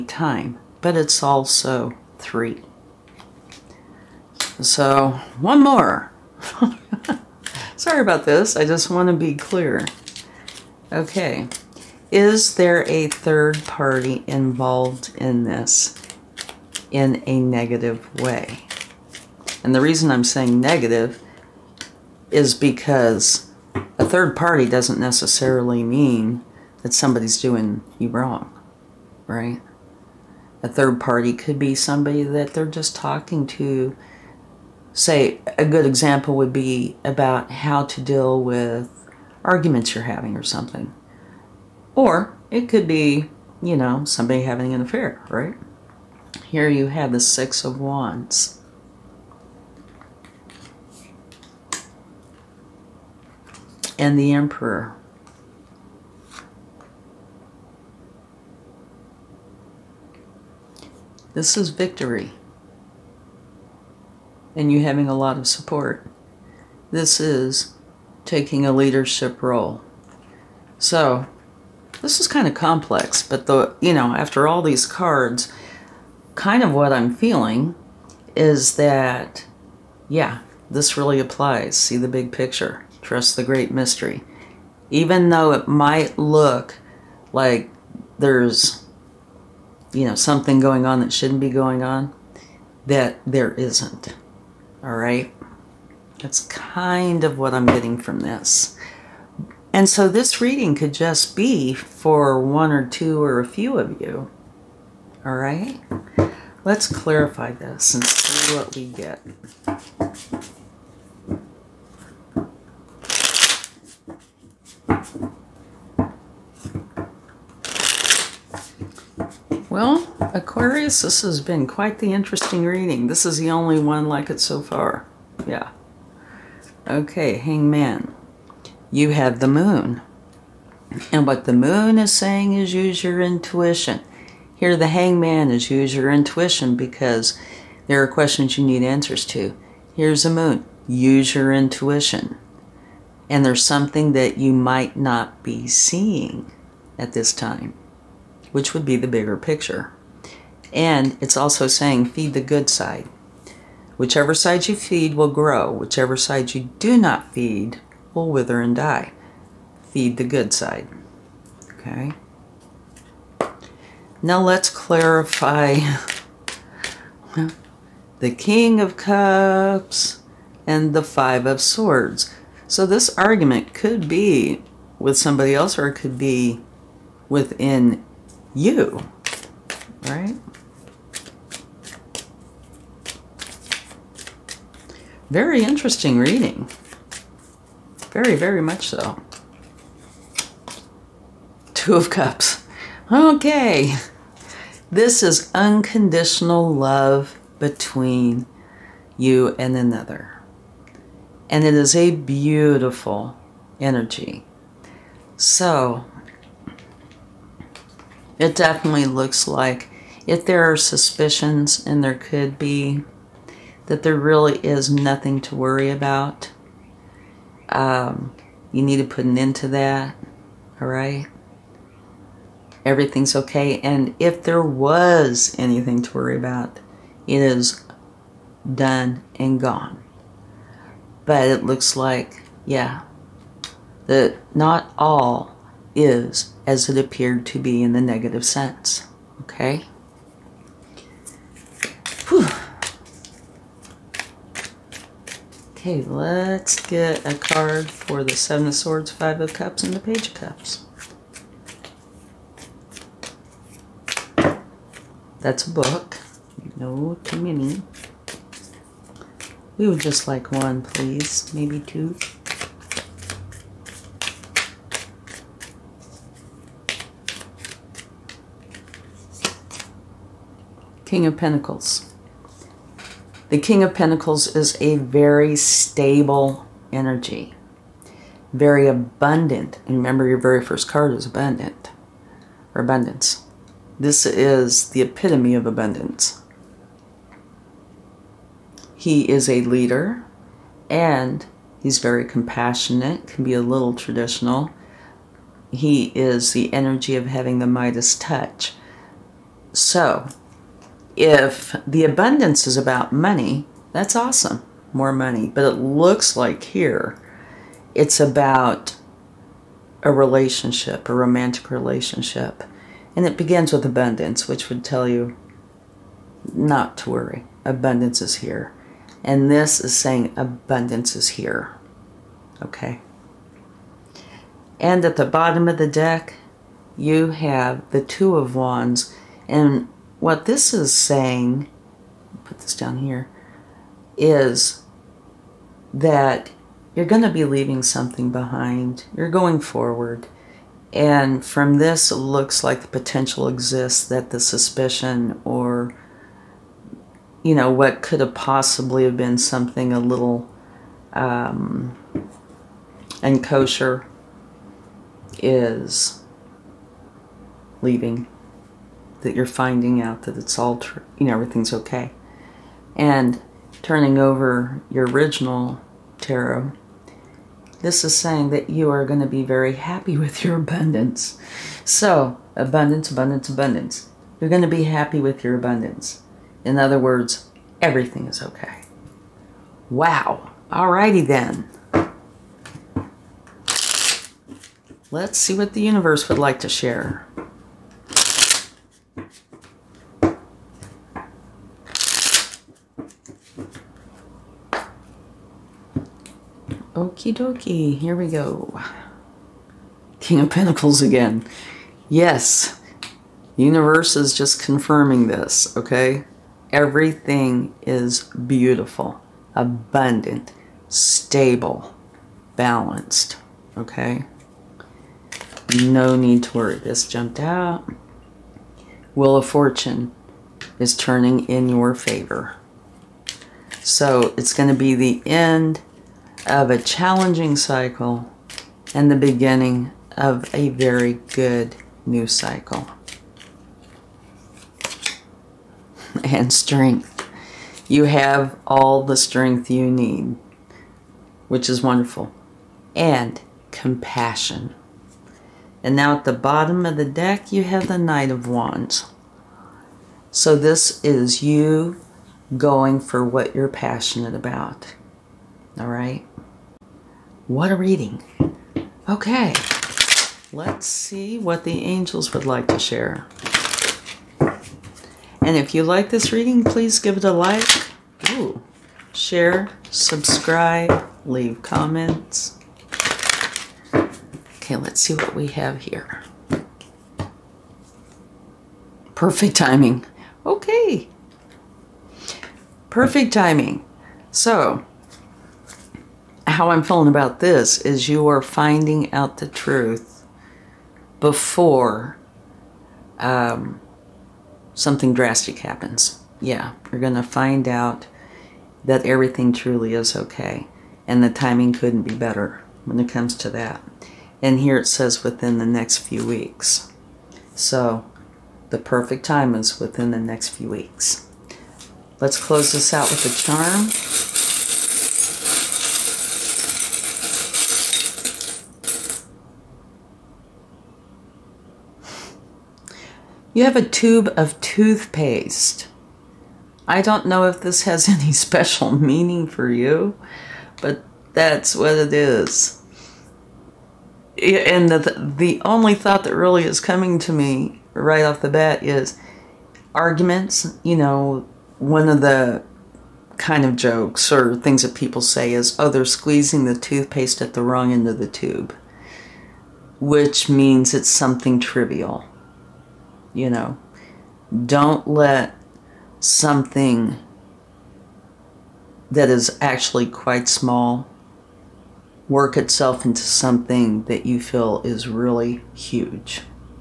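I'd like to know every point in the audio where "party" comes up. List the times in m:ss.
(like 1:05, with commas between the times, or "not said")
0:13, 0:24, 0:30.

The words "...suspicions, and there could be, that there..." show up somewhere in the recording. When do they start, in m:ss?
3:30.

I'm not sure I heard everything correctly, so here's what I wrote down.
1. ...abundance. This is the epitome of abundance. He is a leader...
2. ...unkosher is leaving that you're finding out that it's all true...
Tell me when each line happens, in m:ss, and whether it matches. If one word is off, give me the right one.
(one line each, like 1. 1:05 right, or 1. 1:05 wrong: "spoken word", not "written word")
1. 4:42 right
2. 5:53 right.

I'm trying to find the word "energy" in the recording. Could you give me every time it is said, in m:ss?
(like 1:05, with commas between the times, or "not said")
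3:23, 4:36, 4:56.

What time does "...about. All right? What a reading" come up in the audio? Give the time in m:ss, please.
7:34.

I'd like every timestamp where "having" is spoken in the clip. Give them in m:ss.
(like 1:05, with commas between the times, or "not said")
0:40, 0:44, 1:04, 4:57.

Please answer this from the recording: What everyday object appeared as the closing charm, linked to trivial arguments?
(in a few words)
Tube of toothpaste.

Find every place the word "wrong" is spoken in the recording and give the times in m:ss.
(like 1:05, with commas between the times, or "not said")
0:28, 9:07.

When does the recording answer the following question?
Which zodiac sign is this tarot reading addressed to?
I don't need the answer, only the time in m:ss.
2:00.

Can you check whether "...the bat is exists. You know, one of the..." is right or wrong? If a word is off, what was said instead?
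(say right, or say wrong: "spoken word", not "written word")
wrong: "arguments", not "exists".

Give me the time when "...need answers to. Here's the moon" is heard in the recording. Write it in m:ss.
2:18.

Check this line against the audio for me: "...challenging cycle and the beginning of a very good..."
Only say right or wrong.
right.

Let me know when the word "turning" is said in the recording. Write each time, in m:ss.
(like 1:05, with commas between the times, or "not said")
6:03, 7:00.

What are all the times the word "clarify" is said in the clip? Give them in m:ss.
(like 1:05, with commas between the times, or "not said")
1:46, 2:44.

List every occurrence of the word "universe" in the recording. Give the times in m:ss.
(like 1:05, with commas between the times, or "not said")
6:25, 6:43.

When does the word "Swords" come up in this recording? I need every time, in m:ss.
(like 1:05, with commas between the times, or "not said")
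2:51, 4:08.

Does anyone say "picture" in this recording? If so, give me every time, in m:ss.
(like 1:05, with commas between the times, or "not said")
1:22, 2:29.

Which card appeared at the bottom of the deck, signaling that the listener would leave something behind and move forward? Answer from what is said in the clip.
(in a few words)
Two of Wands.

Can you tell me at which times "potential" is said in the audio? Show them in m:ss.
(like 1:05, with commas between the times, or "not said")
5:42.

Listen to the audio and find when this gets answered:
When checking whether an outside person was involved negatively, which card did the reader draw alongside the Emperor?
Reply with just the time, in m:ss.
0:47.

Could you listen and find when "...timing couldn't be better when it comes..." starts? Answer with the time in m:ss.
8:21.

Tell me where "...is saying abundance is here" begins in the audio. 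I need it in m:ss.
5:19.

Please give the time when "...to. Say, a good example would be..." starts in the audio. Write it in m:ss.
0:33.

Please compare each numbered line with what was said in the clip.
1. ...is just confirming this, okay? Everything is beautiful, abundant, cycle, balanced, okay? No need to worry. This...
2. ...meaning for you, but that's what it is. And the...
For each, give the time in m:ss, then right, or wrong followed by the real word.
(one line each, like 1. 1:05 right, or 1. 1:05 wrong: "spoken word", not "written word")
1. 6:44 wrong: "stable", not "cycle"
2. 8:48 right.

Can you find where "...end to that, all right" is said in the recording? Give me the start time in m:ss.
3:39.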